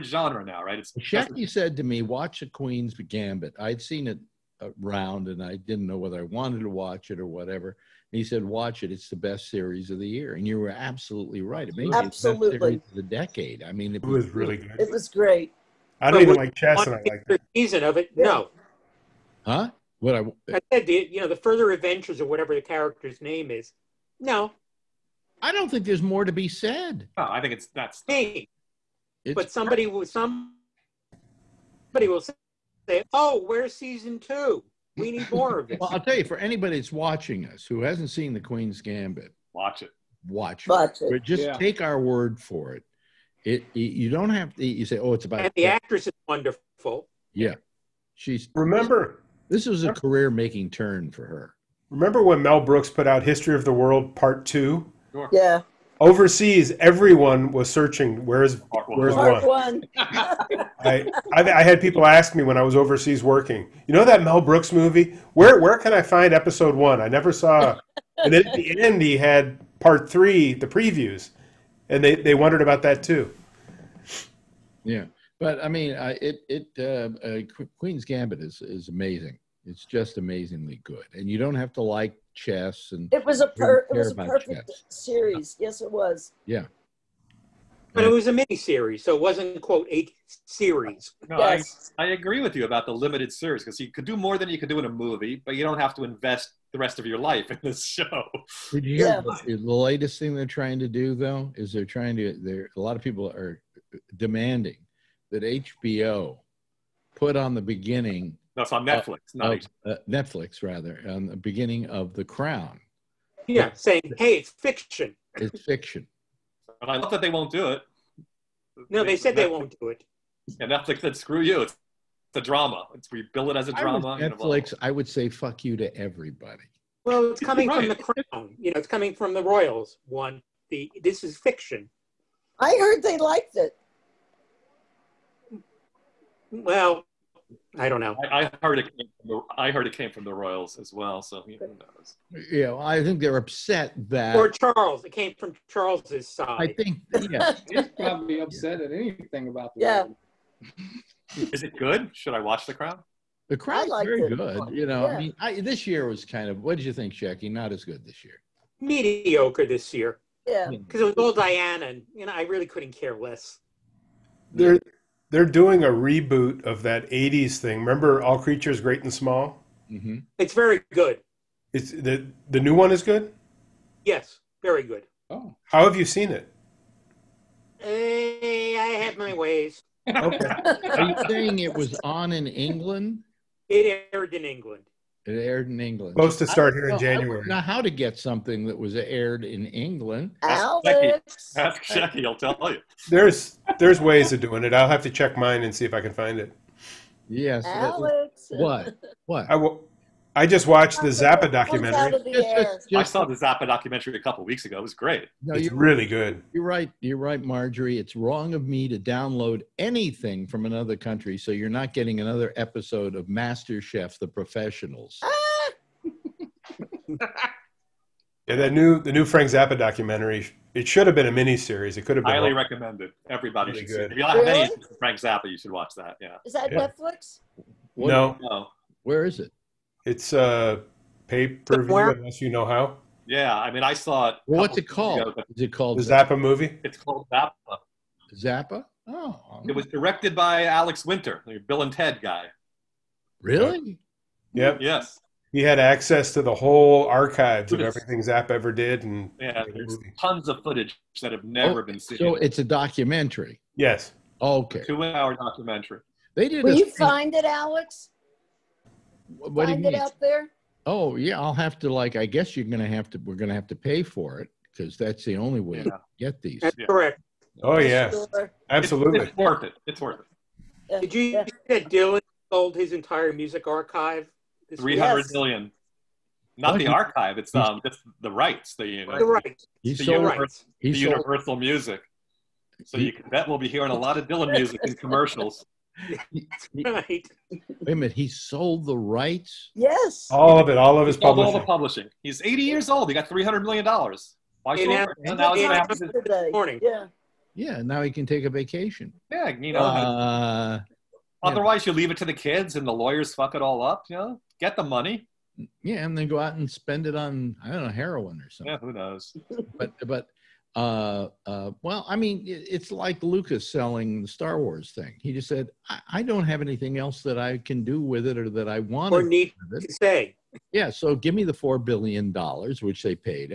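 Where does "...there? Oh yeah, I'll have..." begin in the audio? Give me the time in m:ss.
4:20.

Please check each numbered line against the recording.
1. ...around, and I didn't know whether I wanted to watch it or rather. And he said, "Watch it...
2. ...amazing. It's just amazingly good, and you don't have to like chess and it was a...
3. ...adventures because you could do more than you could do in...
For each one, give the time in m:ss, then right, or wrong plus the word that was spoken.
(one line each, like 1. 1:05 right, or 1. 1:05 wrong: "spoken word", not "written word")
1. 0:04 wrong: "whatever", not "rather"
2. 1:18 right
3. 1:33 wrong: "series", not "adventures".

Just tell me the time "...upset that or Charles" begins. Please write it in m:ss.
2:23.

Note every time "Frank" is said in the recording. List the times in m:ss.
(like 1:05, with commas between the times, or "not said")
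3:39, 3:44.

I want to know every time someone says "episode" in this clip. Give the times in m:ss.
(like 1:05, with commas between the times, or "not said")
1:06, 3:32.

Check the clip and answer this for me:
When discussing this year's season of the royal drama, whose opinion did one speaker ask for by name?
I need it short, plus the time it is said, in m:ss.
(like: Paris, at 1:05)
Jackie, at 2:37.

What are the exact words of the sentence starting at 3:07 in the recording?
I know how to get something that was aired in England.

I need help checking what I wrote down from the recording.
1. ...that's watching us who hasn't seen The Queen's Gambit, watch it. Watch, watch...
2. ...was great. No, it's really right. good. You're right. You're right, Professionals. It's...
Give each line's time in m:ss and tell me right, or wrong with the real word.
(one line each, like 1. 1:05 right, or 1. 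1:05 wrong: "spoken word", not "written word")
1. 0:36 right
2. 3:24 wrong: "Marjorie", not "Professionals".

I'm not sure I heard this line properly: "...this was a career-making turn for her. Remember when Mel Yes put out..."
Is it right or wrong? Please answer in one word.
wrong.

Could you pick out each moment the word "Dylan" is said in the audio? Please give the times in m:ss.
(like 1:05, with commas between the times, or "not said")
4:31, 4:44.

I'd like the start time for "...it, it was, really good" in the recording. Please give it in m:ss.
0:13.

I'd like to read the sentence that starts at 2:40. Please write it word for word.
Because it was all Diana, and you know, I really couldn't care less.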